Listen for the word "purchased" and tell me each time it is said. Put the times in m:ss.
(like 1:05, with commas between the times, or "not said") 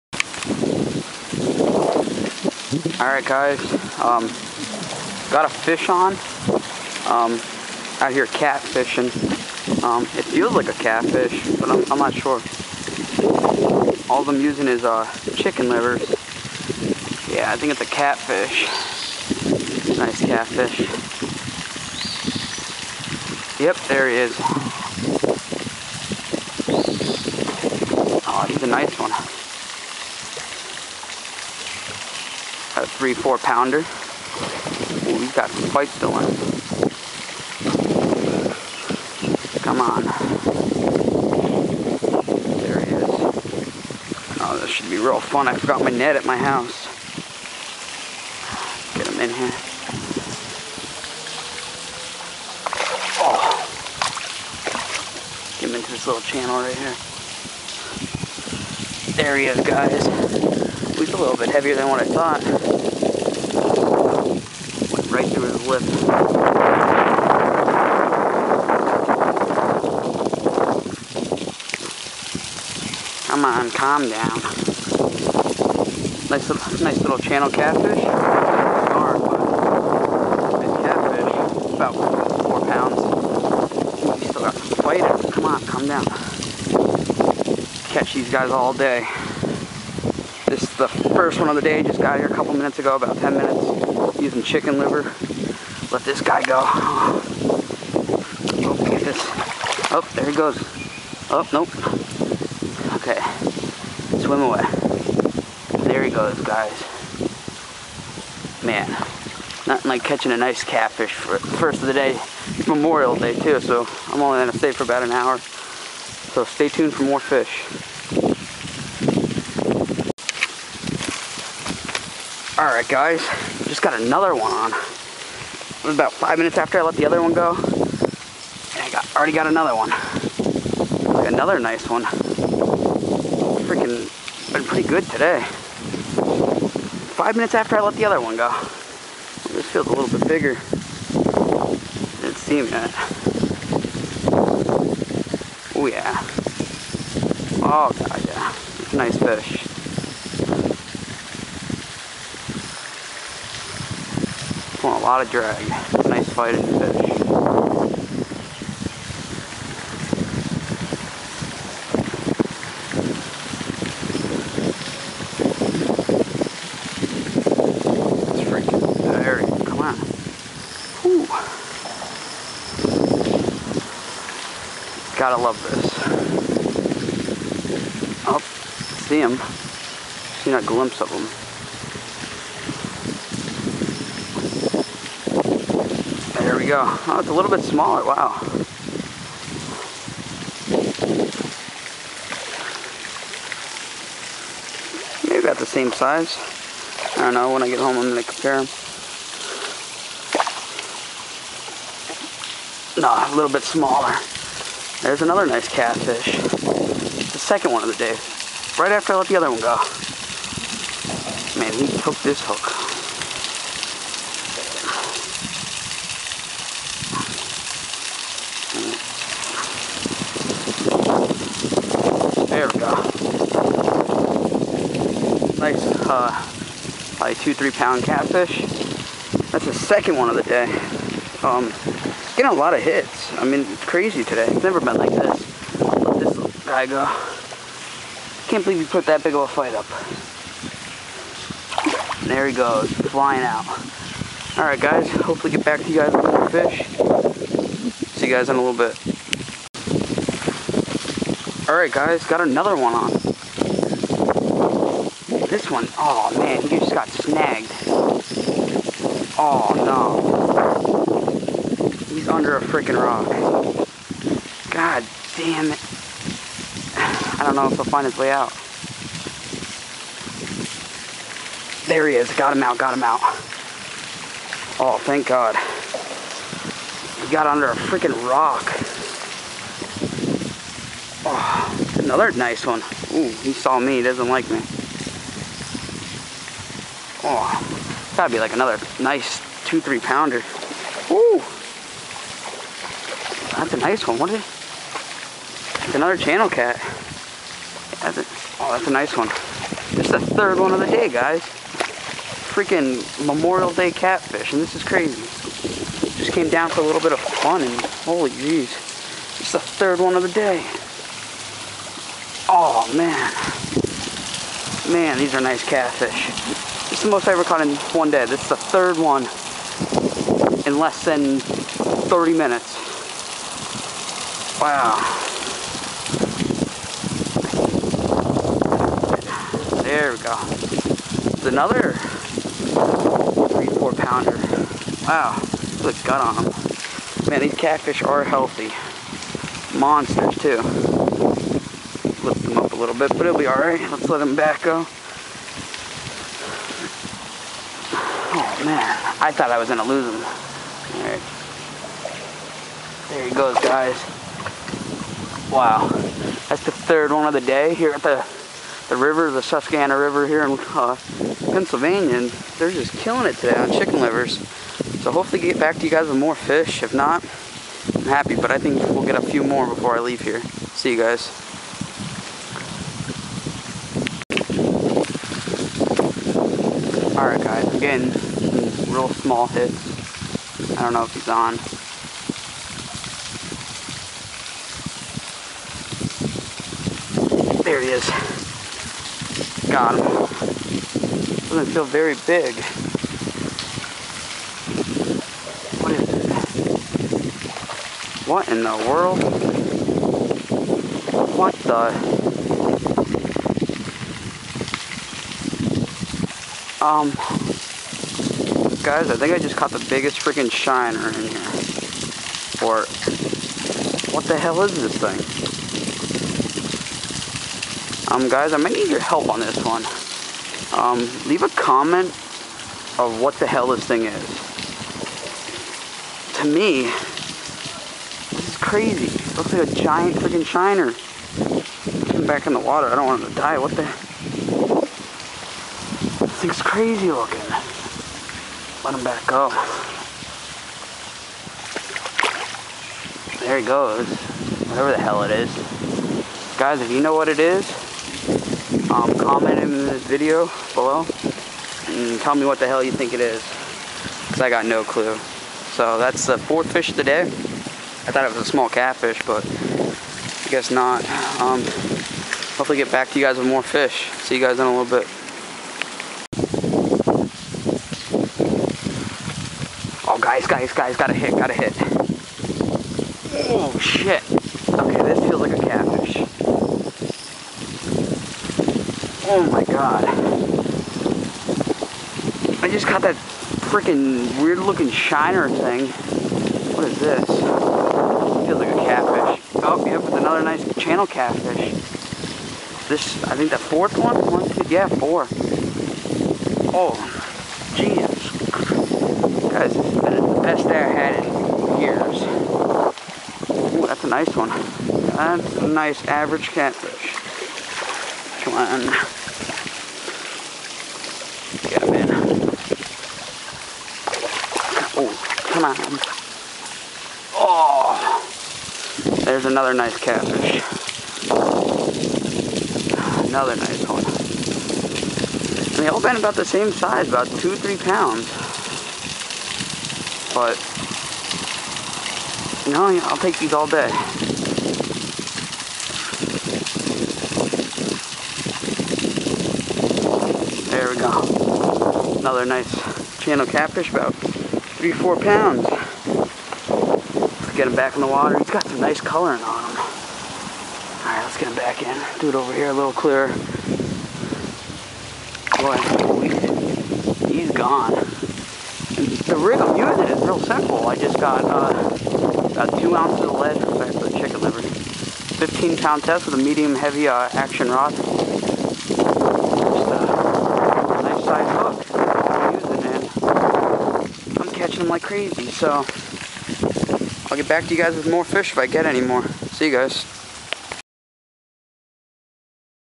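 not said.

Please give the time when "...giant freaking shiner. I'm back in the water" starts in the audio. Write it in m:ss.
7:09.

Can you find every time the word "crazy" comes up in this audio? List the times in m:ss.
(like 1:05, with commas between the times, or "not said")
3:53, 5:04, 7:08, 7:16, 9:35.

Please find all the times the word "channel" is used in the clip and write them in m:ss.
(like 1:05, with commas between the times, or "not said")
0:56, 1:17, 4:56, 8:10, 9:03.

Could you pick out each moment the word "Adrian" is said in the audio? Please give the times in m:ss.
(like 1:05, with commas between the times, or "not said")
not said.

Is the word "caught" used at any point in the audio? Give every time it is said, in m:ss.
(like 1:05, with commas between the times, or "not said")
5:17, 6:49, 8:02.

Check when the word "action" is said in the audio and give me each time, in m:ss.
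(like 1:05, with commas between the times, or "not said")
9:27.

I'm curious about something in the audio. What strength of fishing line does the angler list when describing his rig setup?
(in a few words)
15 pound test.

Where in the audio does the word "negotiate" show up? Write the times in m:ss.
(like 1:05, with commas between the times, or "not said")
not said.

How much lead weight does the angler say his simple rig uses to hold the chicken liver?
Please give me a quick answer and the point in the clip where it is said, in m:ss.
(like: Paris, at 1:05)
2 ounces, at 9:22.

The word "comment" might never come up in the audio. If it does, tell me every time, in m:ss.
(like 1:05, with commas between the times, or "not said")
7:01, 7:29.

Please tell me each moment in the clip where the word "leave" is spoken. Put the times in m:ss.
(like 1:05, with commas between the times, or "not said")
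6:10, 7:01.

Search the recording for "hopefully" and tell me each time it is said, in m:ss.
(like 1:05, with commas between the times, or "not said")
4:05, 6:05, 7:42.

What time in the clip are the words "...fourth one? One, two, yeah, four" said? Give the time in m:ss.
8:13.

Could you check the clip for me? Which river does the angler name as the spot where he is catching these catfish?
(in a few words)
Susquehanna River.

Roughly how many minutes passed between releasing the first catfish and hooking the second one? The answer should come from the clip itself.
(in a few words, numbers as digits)
5 minutes.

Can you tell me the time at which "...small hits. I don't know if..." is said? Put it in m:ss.
6:19.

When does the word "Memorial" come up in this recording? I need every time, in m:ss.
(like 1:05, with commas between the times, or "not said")
1:52, 5:03.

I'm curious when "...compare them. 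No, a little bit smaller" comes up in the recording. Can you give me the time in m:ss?
3:18.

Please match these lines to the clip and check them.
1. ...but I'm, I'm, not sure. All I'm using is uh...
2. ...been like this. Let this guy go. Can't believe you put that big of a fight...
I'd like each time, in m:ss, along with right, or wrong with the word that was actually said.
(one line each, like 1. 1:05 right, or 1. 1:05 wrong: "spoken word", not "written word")
1. 0:11 right
2. 3:54 right.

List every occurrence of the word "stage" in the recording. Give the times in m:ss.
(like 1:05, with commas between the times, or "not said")
not said.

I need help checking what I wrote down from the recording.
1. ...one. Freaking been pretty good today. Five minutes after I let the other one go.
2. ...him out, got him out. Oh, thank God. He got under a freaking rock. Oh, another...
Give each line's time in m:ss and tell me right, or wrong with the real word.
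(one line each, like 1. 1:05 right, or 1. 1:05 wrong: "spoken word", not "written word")
1. 2:11 right
2. 4:32 right.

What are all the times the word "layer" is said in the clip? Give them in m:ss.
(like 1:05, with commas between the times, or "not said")
not said.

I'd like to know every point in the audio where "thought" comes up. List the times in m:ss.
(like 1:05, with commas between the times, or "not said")
1:02, 5:49, 7:38.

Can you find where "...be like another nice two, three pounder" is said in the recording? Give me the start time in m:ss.
4:48.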